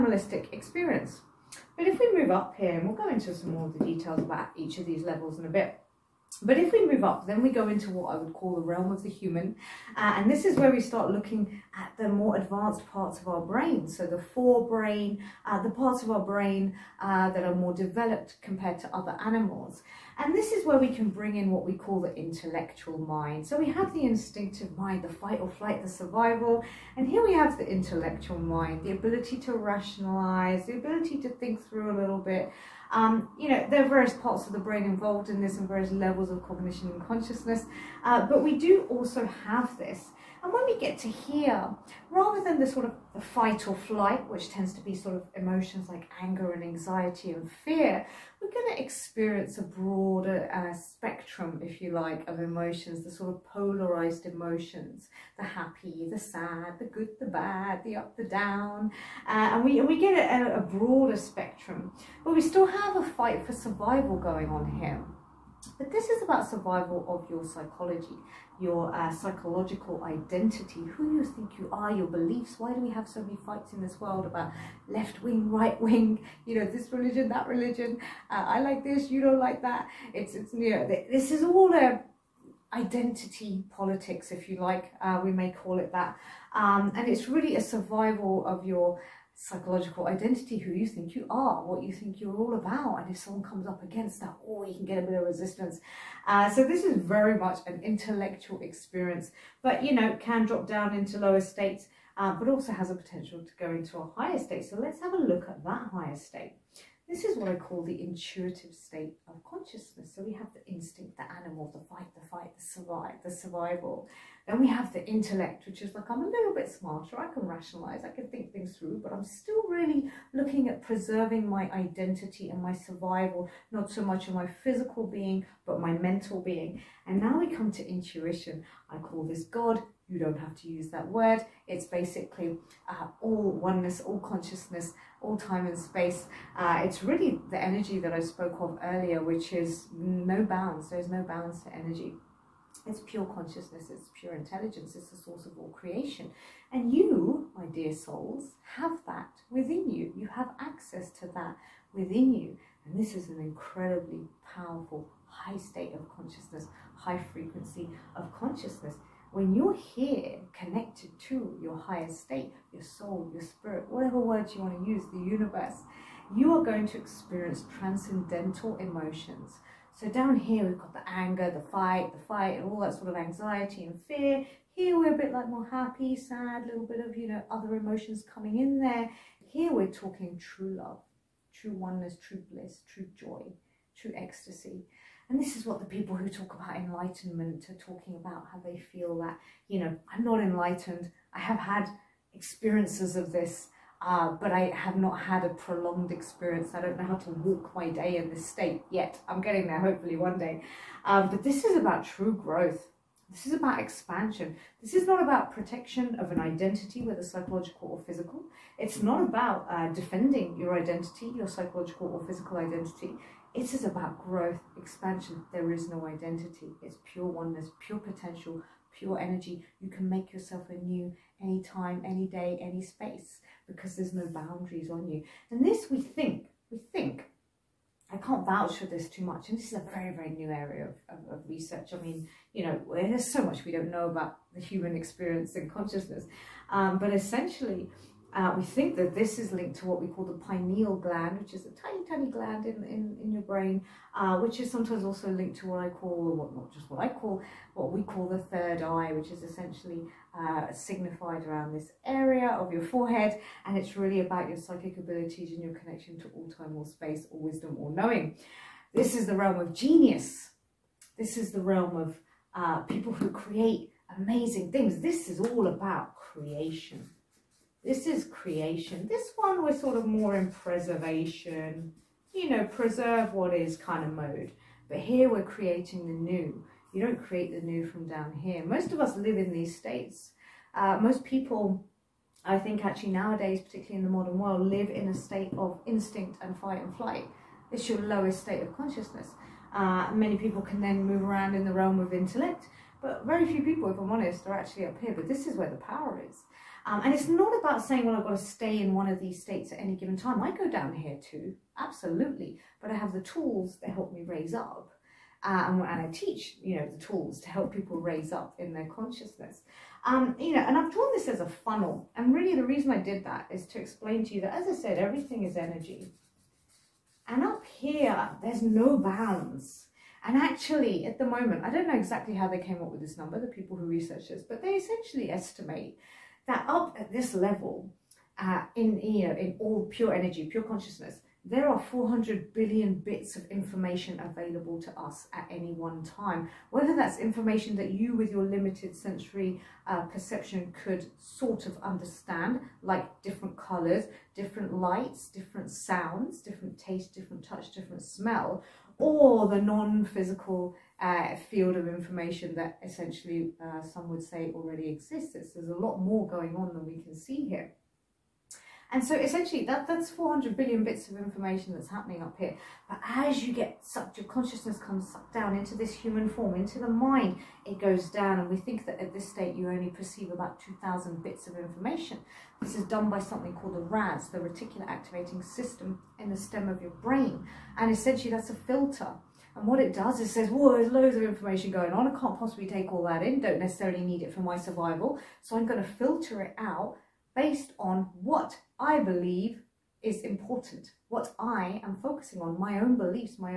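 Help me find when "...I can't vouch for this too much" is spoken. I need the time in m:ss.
3:48.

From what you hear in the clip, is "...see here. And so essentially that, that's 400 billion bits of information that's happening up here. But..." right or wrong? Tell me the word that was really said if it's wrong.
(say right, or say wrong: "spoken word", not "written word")
right.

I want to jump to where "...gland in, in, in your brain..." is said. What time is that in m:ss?
4:02.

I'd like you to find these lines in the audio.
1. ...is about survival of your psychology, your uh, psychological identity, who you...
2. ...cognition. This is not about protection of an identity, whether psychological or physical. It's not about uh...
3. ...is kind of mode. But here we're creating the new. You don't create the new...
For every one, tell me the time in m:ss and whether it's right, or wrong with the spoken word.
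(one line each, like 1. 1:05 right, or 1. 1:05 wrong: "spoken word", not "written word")
1. 1:06 right
2. 3:23 wrong: "expansion", not "cognition"
3. 4:33 right.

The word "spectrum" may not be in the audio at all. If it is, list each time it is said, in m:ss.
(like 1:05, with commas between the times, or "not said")
0:50, 1:01.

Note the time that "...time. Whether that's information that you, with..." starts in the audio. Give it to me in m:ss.
5:36.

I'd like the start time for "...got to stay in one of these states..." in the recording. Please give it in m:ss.
4:58.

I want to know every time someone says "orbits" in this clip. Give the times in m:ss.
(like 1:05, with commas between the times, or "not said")
not said.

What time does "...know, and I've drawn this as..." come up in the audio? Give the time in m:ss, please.
5:10.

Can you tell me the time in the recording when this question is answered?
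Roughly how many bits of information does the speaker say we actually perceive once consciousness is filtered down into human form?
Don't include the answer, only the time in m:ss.
6:10.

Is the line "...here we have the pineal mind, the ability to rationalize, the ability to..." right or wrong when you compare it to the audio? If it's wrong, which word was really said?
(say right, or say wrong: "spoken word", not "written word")
wrong: "intellectual", not "pineal".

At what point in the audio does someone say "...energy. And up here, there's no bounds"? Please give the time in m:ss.
5:15.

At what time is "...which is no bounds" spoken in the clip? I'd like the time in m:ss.
2:19.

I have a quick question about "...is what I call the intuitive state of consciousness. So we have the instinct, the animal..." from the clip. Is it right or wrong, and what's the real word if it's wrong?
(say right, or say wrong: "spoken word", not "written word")
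right.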